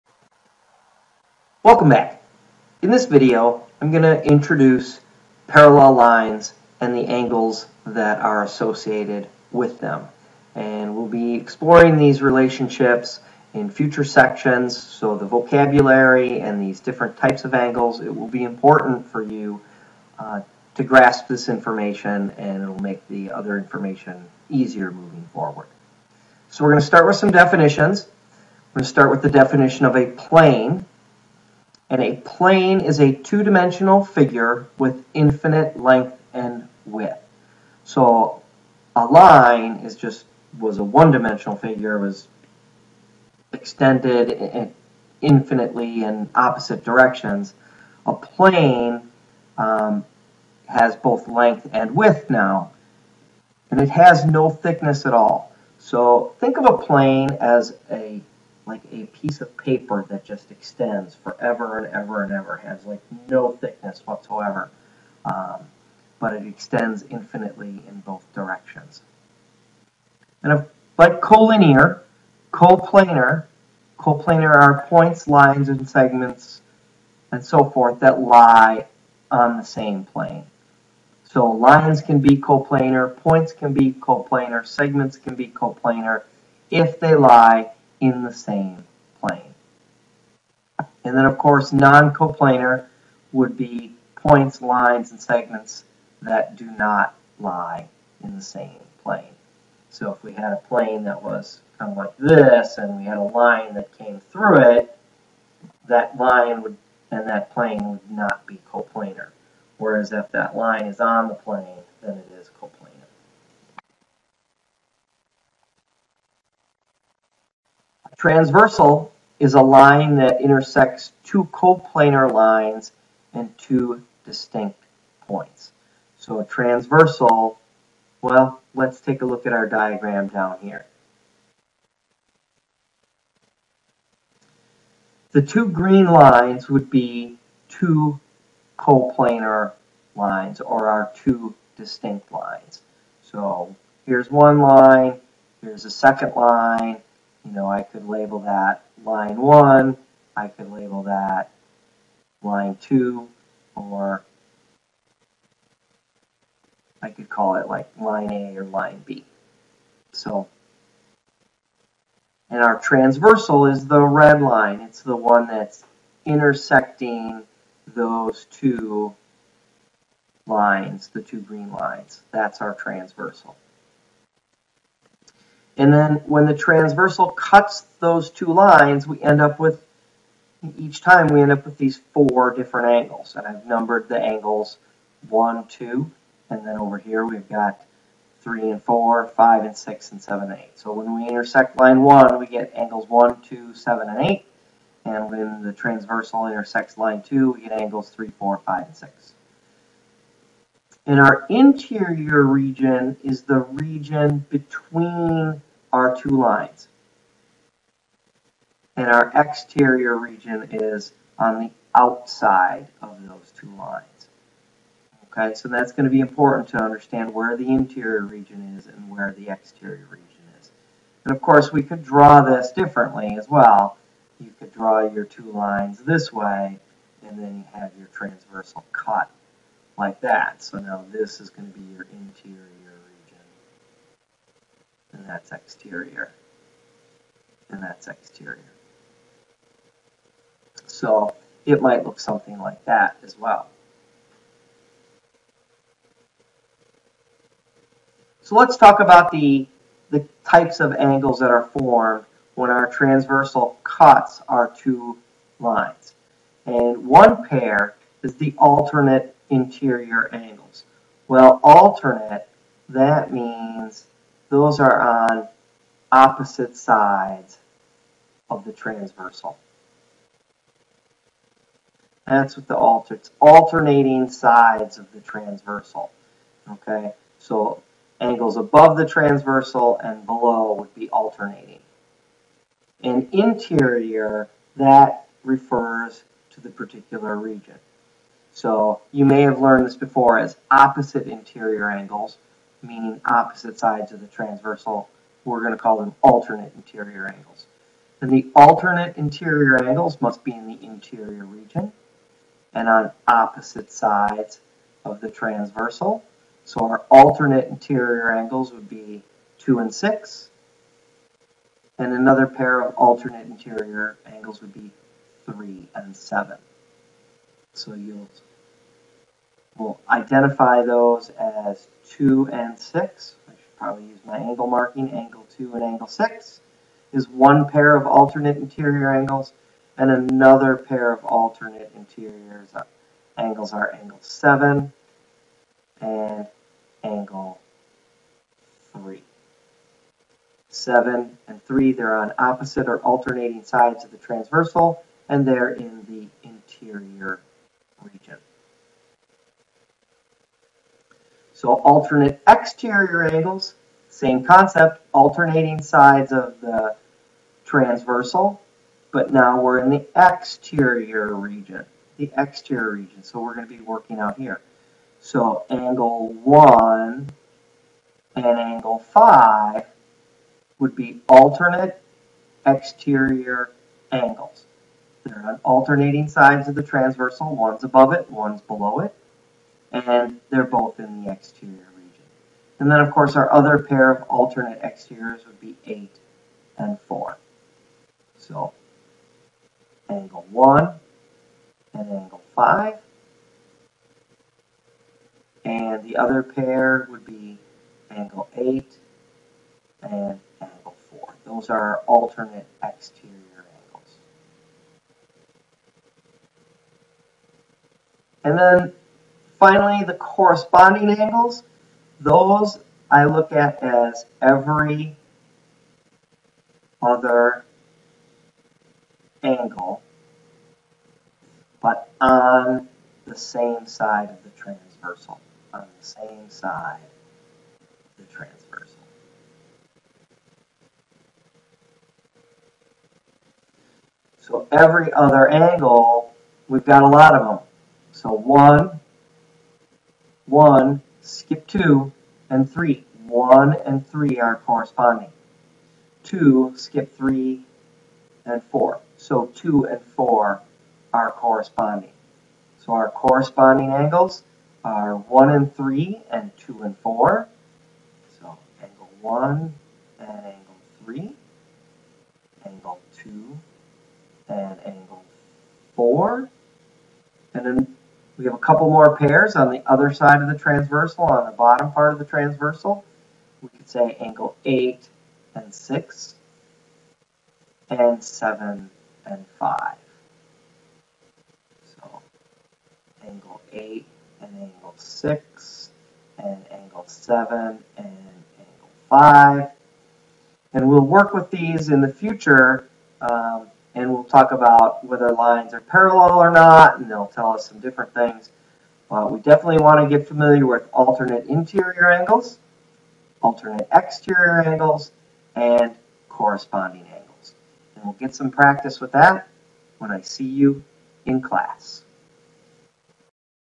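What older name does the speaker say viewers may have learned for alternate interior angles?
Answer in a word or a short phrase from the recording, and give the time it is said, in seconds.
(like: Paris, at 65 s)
Opposite interior angles, at 290 s.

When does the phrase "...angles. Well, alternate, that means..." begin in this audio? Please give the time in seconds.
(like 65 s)
260 s.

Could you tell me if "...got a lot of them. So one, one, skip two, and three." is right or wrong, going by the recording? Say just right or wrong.
right.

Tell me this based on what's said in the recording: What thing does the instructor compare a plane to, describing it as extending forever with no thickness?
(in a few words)
A piece of paper.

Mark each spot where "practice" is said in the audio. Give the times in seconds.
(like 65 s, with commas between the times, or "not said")
508 s.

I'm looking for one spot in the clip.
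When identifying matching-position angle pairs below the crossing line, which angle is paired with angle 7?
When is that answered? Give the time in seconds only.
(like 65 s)
478 s.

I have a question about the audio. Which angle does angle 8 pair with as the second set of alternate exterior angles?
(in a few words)
4.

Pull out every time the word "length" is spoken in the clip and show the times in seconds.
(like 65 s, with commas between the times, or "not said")
35 s, 51 s.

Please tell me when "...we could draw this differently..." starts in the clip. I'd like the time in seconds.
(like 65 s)
221 s.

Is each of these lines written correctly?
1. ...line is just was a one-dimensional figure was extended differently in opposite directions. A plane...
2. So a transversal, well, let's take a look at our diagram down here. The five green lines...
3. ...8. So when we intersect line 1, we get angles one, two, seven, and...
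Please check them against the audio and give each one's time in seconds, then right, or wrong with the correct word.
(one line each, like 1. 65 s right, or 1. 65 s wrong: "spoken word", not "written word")
1. 39 s wrong: "infinitely", not "differently"
2. 126 s wrong: "two", not "five"
3. 190 s right.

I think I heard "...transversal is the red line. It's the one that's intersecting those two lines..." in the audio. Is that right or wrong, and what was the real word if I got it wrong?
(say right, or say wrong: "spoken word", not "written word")
right.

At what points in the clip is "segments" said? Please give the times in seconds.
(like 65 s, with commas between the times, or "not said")
75 s, 84 s, 95 s.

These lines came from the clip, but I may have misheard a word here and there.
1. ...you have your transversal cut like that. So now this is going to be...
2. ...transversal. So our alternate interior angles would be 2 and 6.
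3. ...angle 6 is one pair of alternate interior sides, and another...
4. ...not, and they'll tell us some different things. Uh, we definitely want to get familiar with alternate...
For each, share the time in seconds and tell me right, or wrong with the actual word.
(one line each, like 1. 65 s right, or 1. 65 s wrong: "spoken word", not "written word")
1. 227 s right
2. 305 s right
3. 325 s wrong: "angles", not "sides"
4. 496 s right.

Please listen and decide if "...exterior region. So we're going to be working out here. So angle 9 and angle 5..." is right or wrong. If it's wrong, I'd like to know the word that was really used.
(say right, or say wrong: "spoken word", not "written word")
wrong: "1", not "9".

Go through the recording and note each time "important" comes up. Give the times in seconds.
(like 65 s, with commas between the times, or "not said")
18 s, 216 s.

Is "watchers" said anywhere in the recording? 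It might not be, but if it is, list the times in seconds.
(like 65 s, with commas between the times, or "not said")
not said.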